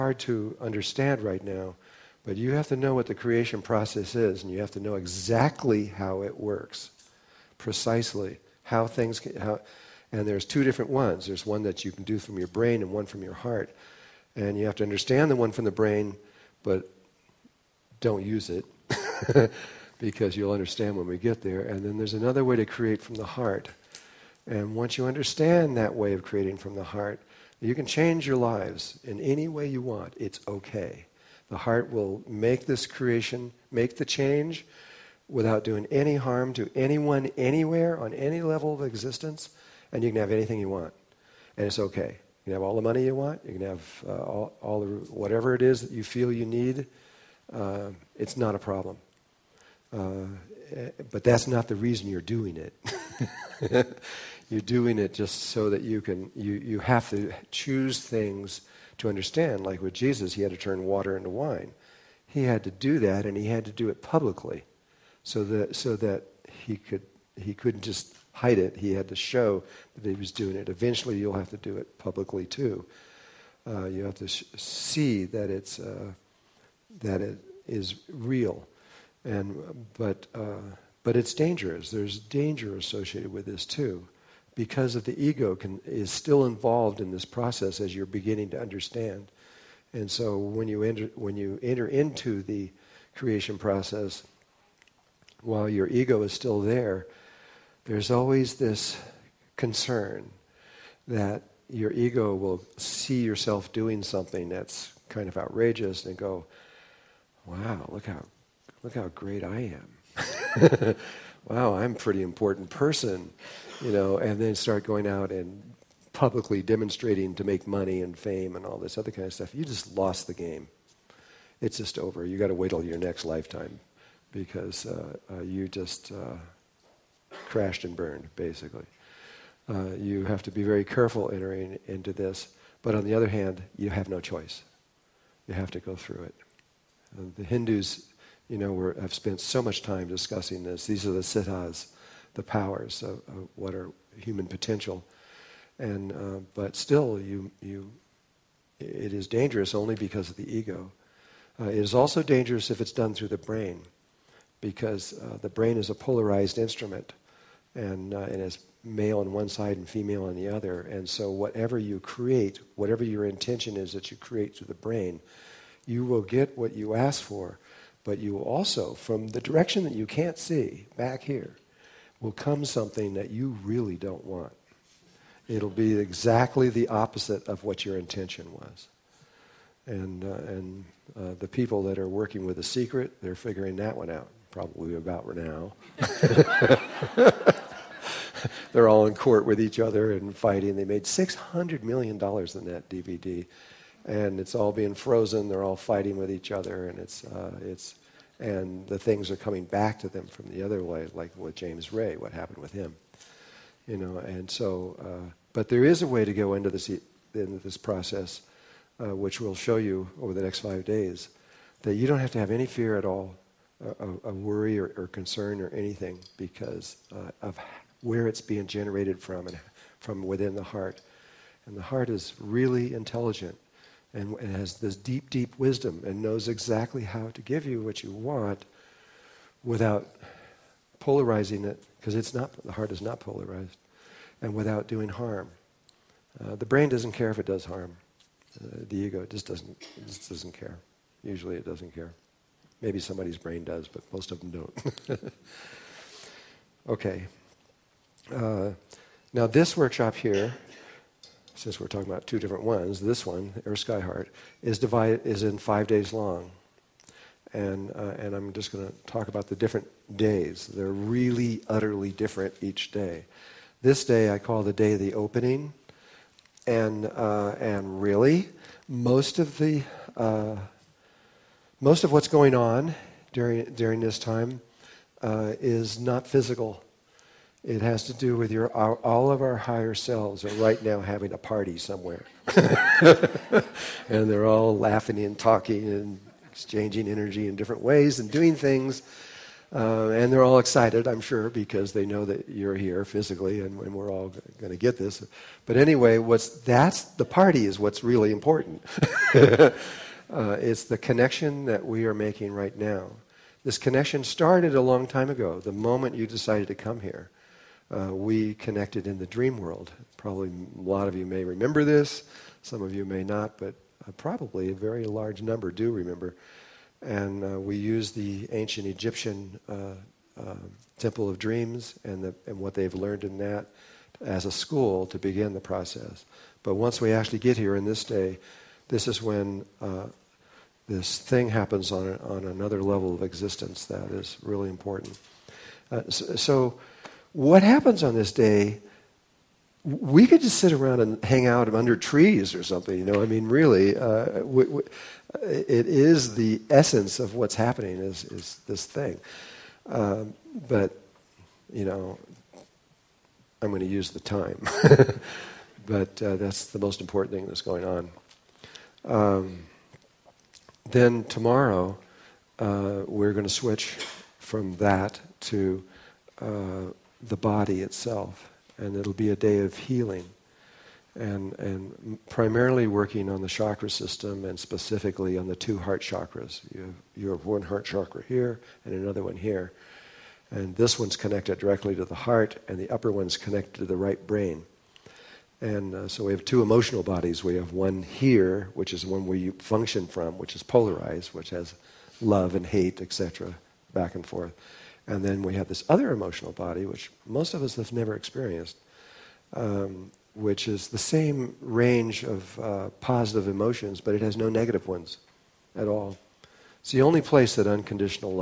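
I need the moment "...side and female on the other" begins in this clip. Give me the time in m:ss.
2:39.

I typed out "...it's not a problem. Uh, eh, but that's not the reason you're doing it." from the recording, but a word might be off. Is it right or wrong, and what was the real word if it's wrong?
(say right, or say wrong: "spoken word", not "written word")
right.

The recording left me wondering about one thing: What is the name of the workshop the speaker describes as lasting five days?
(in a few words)
Earth Sky Heart.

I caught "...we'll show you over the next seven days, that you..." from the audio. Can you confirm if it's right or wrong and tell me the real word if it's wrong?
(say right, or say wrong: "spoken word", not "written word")
wrong: "five", not "seven".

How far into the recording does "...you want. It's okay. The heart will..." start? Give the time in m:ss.
0:29.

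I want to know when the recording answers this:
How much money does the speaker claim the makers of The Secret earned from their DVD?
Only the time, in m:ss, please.
3:11.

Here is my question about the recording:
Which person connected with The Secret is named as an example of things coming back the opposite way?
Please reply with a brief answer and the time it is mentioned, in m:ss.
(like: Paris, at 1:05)
James Ray, at 3:21.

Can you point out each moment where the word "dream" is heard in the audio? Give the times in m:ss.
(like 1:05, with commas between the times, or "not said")
5:09, 5:21.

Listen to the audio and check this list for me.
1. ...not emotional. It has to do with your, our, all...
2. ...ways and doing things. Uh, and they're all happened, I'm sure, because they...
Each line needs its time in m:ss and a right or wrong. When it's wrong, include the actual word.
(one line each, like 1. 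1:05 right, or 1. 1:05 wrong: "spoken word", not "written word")
1. 4:36 wrong: "physical", not "emotional"
2. 4:47 wrong: "excited", not "happened".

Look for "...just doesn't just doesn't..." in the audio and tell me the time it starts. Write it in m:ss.
3:59.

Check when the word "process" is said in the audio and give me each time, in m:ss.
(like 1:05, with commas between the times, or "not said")
0:03, 1:27, 1:33, 3:27, 5:25.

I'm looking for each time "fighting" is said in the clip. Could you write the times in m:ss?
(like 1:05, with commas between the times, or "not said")
3:10, 3:15.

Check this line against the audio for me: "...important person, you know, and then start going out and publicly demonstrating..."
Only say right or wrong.
right.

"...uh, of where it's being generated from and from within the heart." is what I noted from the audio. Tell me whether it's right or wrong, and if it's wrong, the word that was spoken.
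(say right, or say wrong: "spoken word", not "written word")
right.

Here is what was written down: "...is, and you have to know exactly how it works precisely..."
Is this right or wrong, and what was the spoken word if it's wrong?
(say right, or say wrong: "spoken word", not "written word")
right.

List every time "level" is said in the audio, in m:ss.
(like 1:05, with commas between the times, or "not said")
0:38, 5:32.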